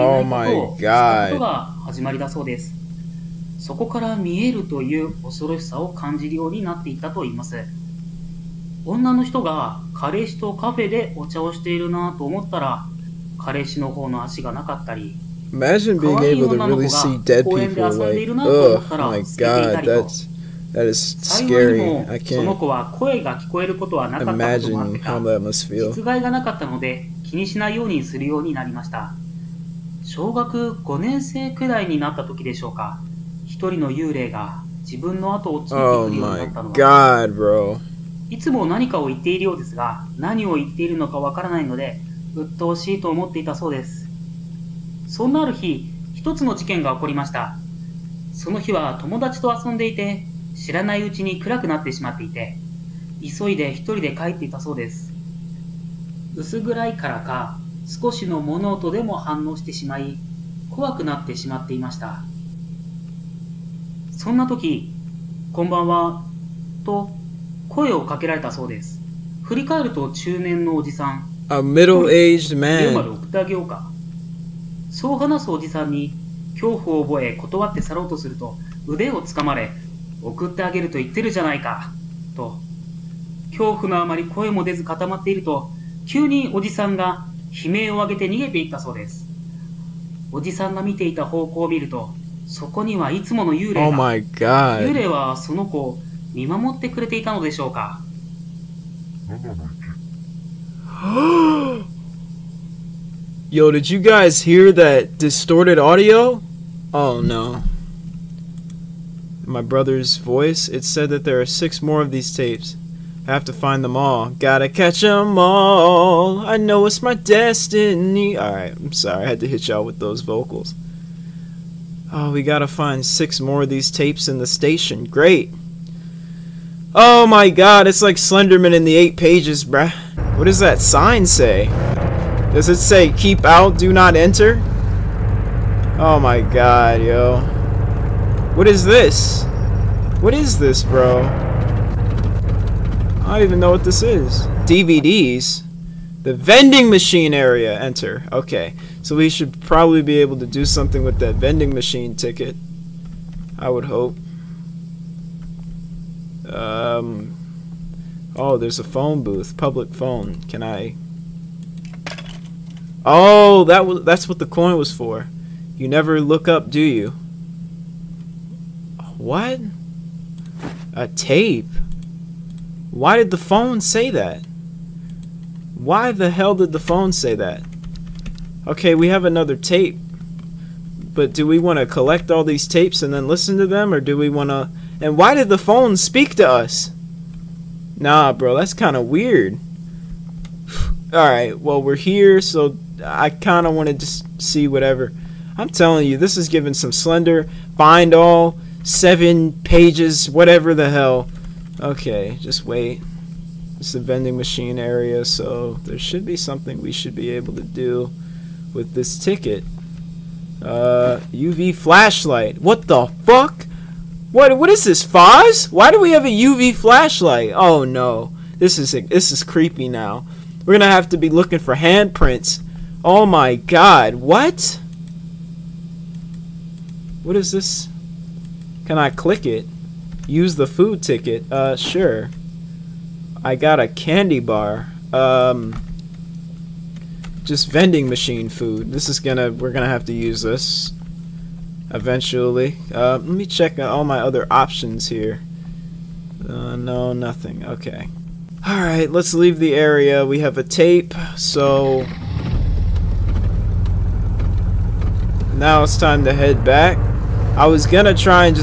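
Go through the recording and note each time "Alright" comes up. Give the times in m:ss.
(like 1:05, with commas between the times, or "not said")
1:58, 3:11, 4:08.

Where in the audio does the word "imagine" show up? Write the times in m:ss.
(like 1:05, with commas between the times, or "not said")
0:15, 0:24.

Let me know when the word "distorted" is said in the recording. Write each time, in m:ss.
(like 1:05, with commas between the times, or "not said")
1:45.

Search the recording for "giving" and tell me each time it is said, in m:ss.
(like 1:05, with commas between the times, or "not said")
3:16.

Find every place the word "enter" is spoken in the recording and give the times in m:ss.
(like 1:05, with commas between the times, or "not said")
2:14, 2:27.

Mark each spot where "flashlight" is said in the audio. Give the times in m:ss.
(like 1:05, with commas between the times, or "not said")
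3:31, 3:36.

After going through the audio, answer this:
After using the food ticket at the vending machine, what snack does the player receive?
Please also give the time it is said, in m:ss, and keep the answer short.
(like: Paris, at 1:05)
A candy bar, at 3:53.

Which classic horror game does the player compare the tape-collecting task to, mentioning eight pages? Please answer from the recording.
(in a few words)
Slenderman.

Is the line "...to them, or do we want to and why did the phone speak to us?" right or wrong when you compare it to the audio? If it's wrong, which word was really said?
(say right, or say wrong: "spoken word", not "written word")
right.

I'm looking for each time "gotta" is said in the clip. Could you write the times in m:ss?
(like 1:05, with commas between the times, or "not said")
1:54, 2:02.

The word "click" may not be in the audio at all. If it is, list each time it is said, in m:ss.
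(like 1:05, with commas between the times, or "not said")
3:49.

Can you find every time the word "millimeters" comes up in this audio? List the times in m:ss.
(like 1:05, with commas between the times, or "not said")
not said.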